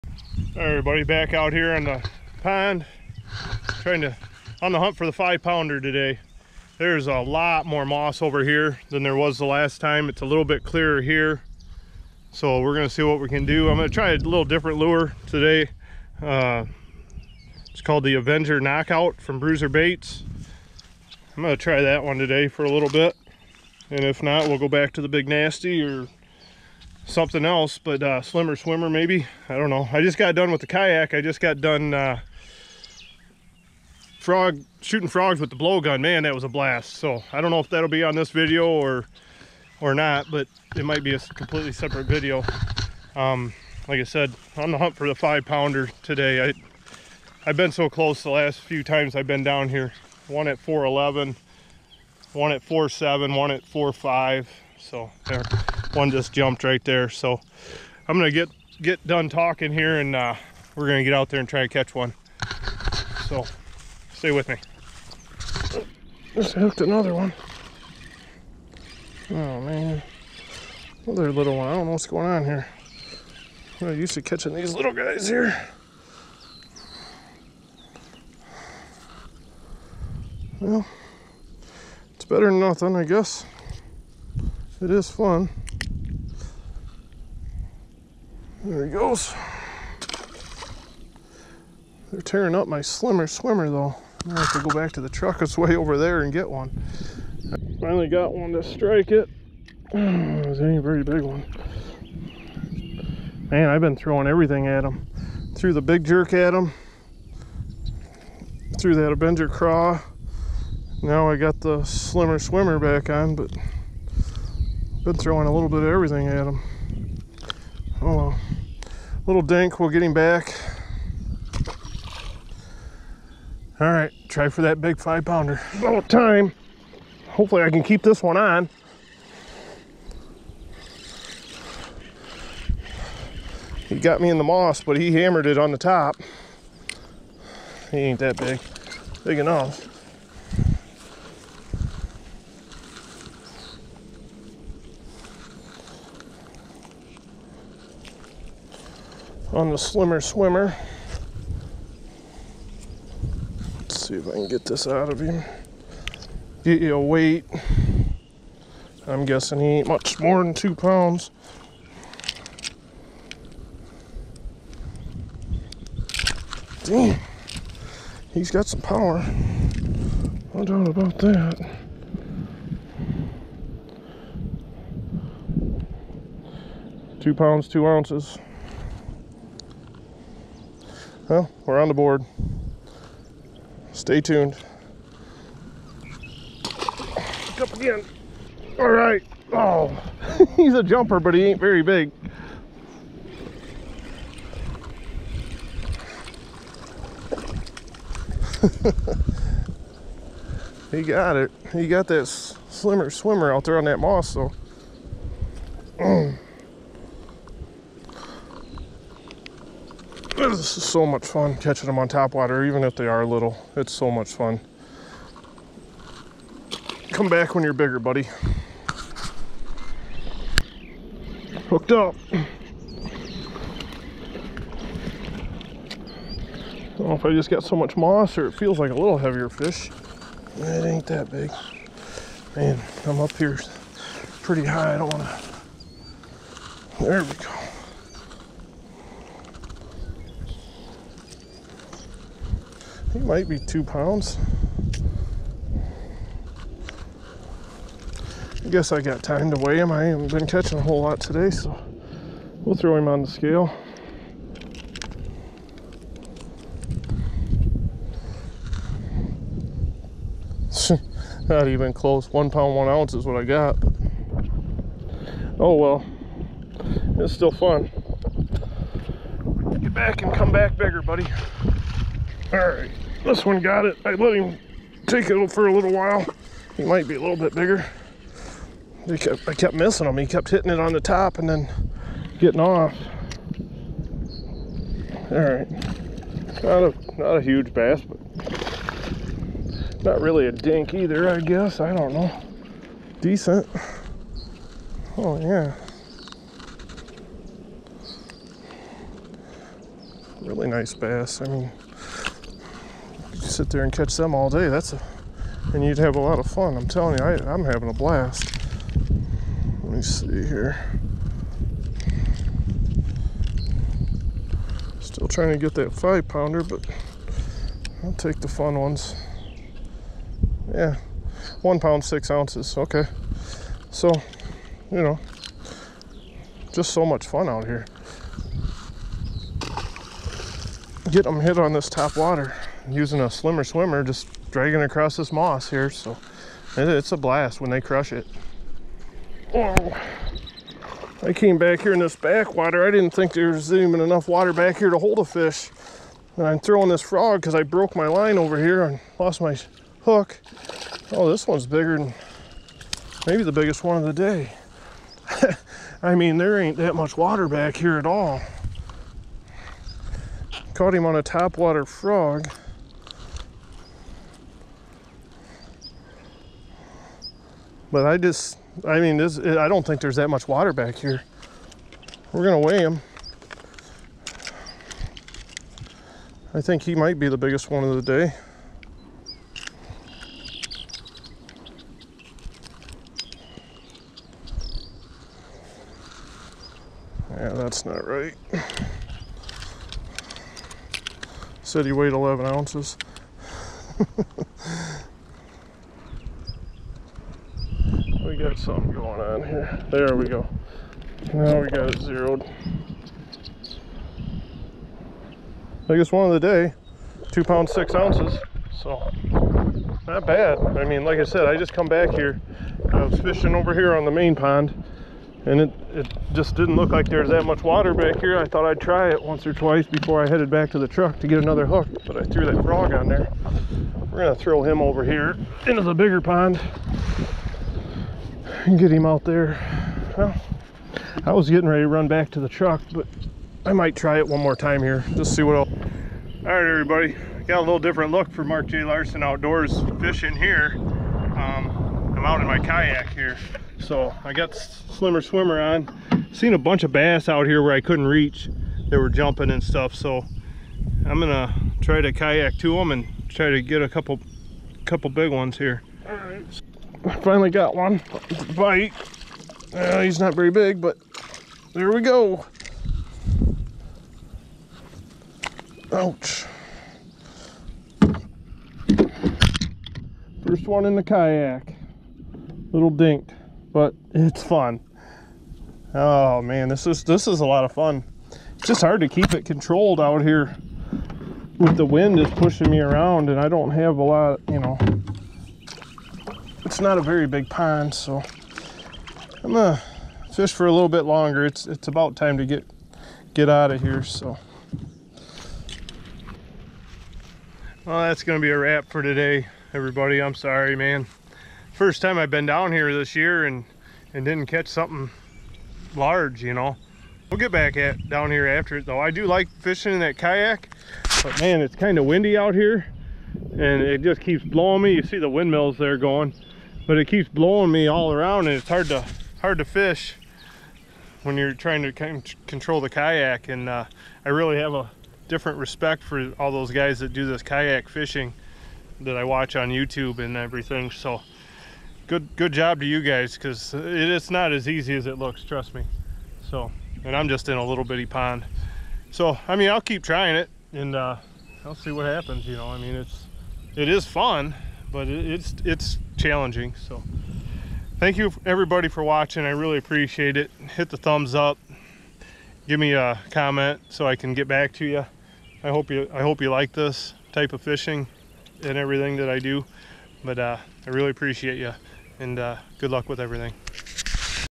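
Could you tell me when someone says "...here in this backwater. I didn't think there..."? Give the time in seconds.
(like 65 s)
341 s.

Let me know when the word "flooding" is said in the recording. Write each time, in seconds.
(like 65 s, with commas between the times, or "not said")
not said.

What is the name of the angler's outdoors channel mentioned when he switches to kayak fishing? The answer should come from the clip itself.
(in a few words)
Mark J. Larson Outdoors.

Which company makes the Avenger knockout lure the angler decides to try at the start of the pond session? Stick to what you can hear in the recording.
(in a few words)
Bruiser Baits.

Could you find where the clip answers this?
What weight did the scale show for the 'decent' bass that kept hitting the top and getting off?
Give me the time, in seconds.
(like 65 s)
321 s.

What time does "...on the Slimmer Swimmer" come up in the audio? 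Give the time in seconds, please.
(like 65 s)
149 s.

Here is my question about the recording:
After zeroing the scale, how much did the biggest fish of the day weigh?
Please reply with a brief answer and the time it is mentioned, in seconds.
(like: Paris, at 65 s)
2 pounds, 6 ounces, at 407 s.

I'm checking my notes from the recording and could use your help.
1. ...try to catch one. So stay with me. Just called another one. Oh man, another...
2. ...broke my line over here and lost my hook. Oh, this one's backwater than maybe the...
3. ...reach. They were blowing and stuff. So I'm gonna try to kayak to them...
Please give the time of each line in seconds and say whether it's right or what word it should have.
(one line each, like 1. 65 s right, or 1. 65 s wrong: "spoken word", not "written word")
1. 61 s wrong: "hooked", not "called"
2. 347 s wrong: "bigger", not "backwater"
3. 448 s wrong: "jumping", not "blowing".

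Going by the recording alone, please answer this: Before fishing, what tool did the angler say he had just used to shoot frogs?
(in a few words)
blowgun.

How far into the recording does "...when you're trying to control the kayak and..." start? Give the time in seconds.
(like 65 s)
521 s.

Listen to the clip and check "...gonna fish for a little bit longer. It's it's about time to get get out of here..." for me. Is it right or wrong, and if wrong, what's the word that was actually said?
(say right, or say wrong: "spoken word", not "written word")
right.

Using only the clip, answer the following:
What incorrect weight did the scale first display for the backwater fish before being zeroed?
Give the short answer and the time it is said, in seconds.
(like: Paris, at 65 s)
11 ounces, at 392 s.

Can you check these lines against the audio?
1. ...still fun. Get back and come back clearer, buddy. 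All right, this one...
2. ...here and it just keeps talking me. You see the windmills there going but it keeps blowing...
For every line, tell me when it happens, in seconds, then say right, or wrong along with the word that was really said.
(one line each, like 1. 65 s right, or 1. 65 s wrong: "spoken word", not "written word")
1. 267 s wrong: "bigger", not "clearer"
2. 512 s wrong: "blowing", not "talking".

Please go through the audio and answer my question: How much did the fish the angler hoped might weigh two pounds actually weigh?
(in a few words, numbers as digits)
1 pound, 1 ounce.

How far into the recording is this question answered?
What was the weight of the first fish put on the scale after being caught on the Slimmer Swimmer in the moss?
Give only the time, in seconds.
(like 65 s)
177 s.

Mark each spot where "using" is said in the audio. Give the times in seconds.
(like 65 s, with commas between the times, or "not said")
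332 s.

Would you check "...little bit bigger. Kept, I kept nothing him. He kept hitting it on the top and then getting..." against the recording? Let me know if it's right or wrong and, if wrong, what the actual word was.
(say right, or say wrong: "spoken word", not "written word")
wrong: "missing", not "nothing".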